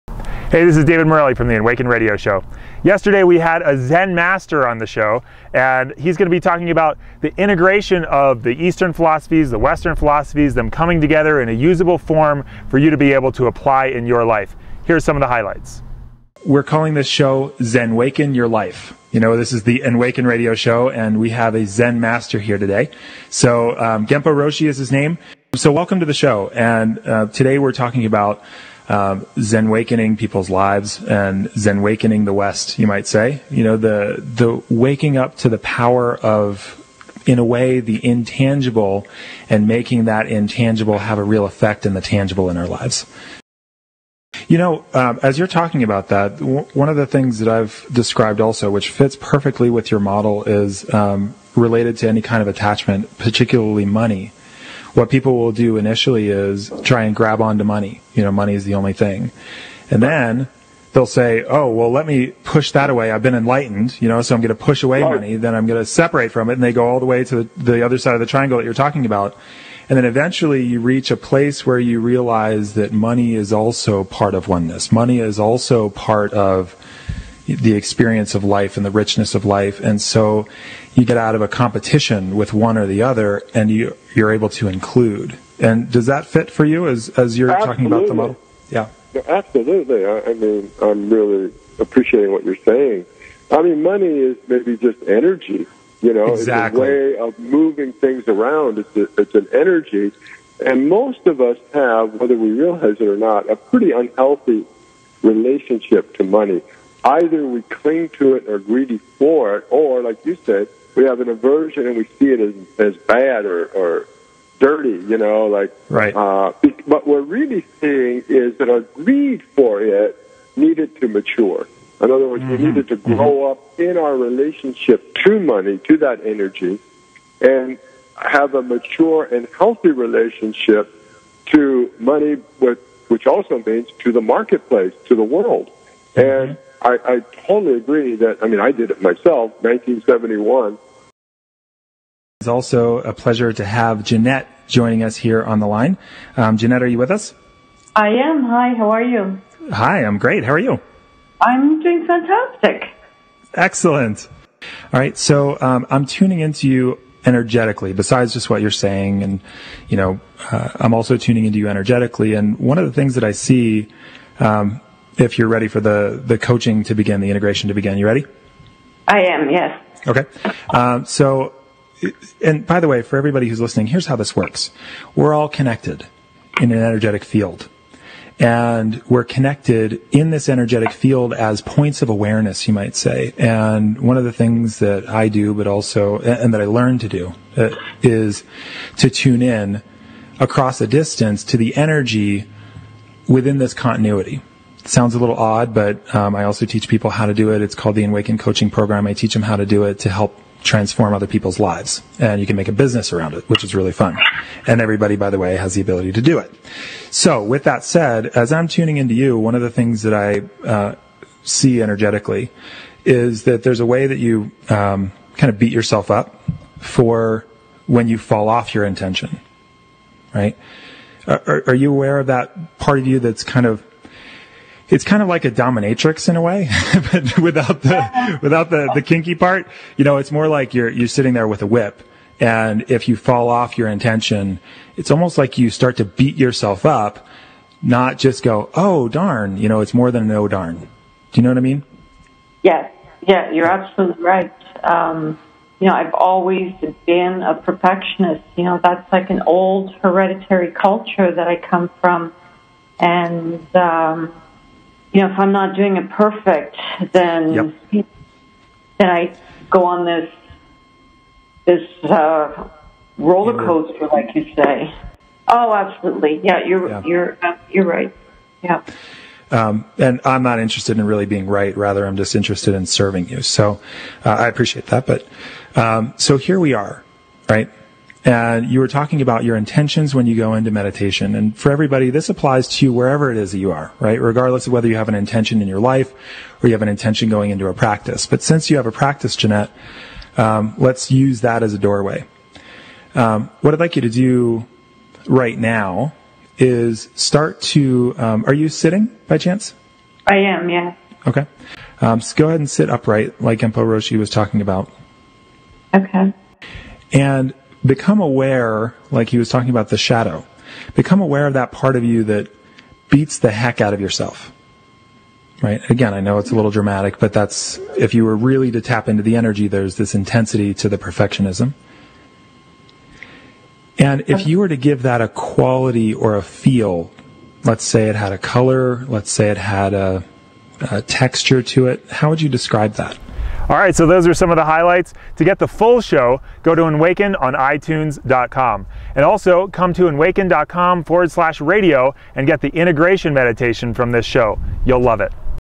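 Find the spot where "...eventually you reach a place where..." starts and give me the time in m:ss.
1:10.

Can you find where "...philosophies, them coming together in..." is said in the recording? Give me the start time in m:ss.
0:09.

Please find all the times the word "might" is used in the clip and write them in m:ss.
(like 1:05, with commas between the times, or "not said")
0:32, 3:02.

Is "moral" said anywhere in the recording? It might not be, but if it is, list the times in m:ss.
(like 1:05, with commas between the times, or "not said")
not said.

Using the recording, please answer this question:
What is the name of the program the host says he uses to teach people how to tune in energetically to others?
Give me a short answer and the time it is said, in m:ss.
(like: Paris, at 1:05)
Enwaken Coaching Program, at 3:18.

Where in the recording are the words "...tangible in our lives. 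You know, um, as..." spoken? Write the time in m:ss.
0:42.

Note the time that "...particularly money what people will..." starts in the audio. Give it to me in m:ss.
0:53.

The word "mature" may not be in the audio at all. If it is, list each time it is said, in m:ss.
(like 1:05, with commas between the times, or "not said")
2:01, 2:08.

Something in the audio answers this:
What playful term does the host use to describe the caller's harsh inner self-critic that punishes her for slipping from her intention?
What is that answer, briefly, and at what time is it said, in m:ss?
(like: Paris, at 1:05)
dominatrix, at 3:45.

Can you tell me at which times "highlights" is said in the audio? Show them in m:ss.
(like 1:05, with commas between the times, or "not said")
0:15, 5:34.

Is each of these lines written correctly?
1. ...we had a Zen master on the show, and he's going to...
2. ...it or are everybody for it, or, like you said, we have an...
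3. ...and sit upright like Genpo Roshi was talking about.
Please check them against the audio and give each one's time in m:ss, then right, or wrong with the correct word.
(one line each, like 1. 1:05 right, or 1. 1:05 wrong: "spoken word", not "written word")
1. 0:03 right
2. 1:48 wrong: "greedy", not "everybody"
3. 5:02 right.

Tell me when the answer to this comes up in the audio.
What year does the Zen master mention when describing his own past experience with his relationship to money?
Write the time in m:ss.
2:19.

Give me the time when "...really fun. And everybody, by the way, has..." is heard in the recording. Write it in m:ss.
3:23.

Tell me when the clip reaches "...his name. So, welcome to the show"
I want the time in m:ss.
0:24.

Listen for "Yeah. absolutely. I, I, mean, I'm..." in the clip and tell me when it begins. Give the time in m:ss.
1:28.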